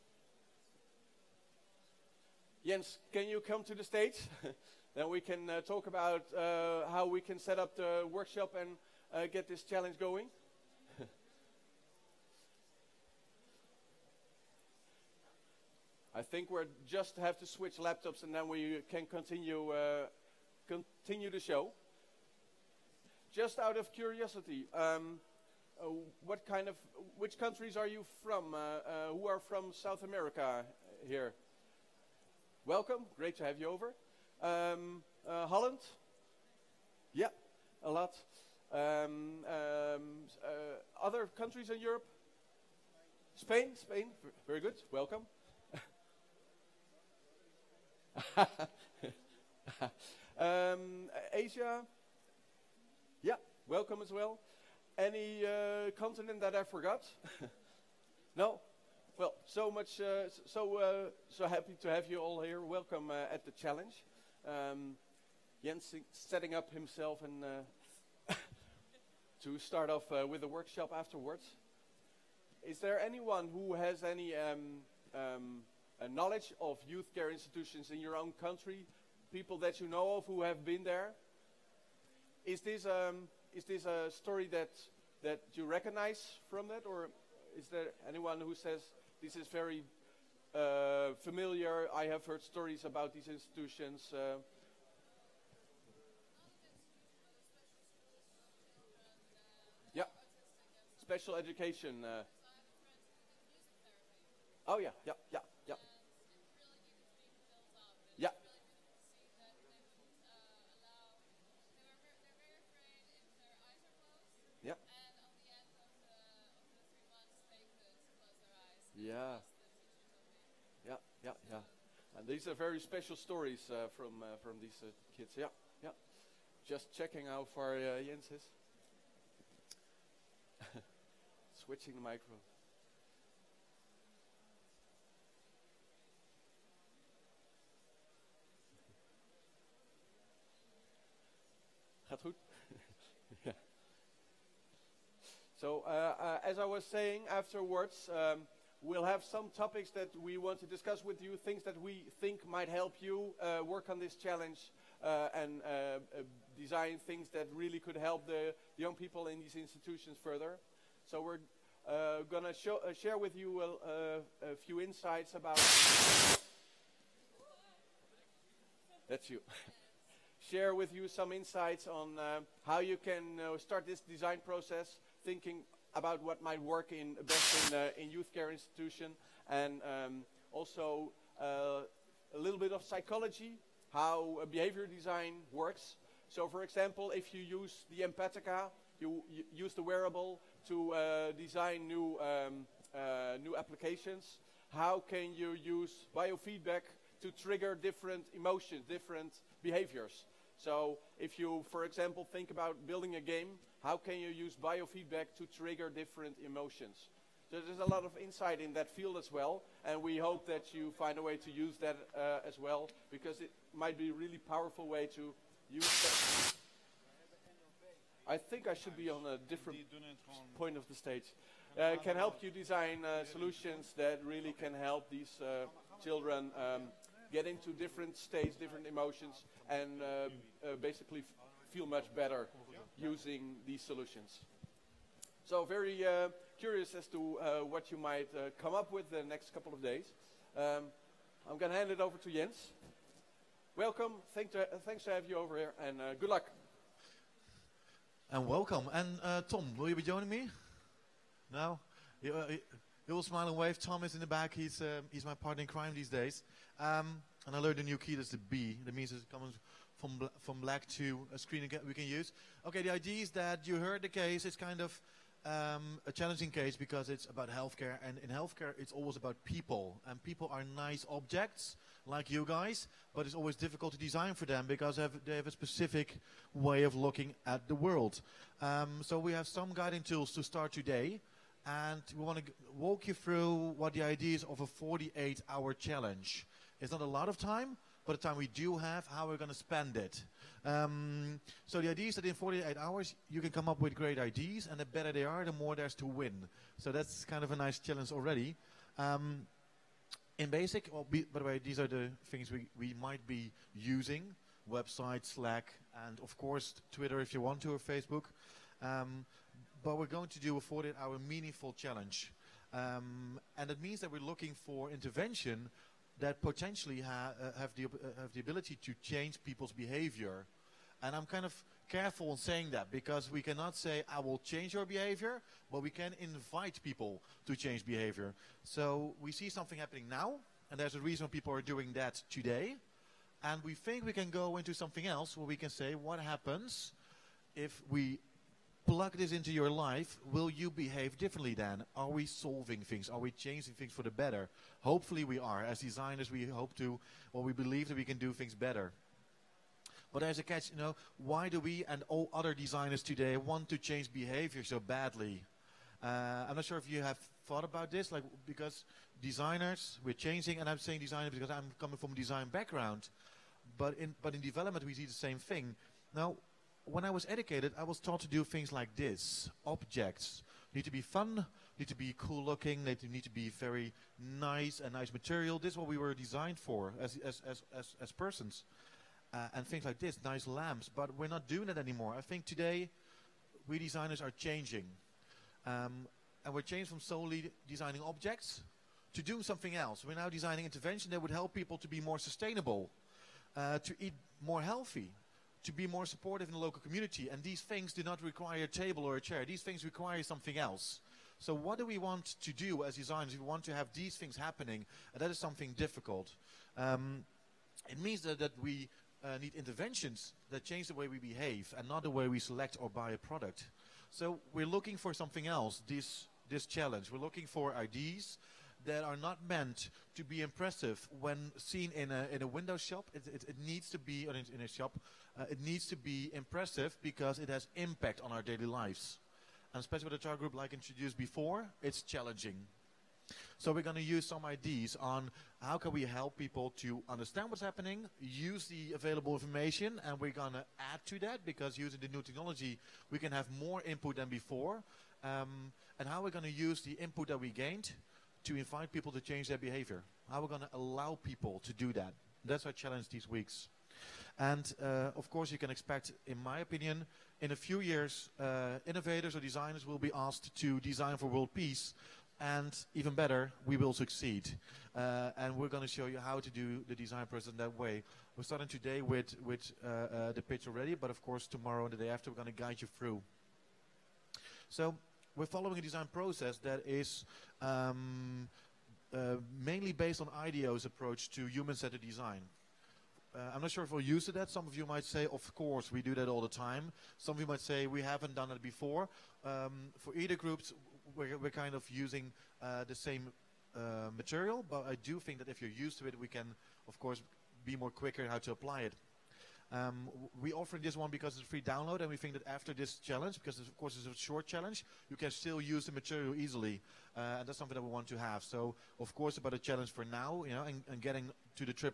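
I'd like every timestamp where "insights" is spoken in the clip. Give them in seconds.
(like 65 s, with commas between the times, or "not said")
164 s, 171 s, 208 s.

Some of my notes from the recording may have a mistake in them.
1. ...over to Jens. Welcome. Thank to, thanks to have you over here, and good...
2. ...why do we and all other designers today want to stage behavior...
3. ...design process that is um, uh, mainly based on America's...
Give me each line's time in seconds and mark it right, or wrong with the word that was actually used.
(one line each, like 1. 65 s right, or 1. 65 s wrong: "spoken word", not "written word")
1. 241 s right
2. 351 s wrong: "change", not "stage"
3. 475 s wrong: "IDEO", not "America".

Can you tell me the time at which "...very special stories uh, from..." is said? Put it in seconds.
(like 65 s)
122 s.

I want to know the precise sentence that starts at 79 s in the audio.
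People that you know of who have been there?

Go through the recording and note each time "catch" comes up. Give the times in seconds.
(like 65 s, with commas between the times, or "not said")
350 s.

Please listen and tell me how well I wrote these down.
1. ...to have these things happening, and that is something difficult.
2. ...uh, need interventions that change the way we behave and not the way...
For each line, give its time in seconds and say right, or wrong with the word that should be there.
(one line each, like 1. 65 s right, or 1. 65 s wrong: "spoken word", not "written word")
1. 403 s right
2. 409 s right.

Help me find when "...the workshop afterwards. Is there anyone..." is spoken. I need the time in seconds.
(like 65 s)
70 s.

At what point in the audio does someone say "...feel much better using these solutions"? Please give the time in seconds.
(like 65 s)
231 s.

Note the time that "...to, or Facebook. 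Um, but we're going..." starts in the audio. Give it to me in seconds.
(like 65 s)
307 s.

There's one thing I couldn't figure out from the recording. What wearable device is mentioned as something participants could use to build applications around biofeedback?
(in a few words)
Empatica.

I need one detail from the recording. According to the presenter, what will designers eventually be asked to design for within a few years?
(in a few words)
world peace.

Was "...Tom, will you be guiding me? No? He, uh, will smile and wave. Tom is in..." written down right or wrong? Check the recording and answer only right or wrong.
wrong.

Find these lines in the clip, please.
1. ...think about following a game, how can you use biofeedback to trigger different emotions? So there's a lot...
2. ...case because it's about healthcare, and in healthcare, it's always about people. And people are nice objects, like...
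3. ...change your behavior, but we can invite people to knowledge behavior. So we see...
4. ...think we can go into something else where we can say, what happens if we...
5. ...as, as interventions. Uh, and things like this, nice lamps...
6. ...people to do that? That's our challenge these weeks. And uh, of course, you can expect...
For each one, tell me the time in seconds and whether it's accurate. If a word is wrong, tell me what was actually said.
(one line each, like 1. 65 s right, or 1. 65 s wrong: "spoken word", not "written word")
1. 202 s wrong: "building", not "following"
2. 266 s right
3. 324 s wrong: "change", not "knowledge"
4. 333 s right
5. 377 s wrong: "persons", not "interventions"
6. 451 s right.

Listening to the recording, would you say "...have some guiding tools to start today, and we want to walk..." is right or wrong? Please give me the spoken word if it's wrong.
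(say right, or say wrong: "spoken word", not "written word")
right.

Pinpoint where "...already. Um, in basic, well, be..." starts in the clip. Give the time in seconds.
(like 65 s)
298 s.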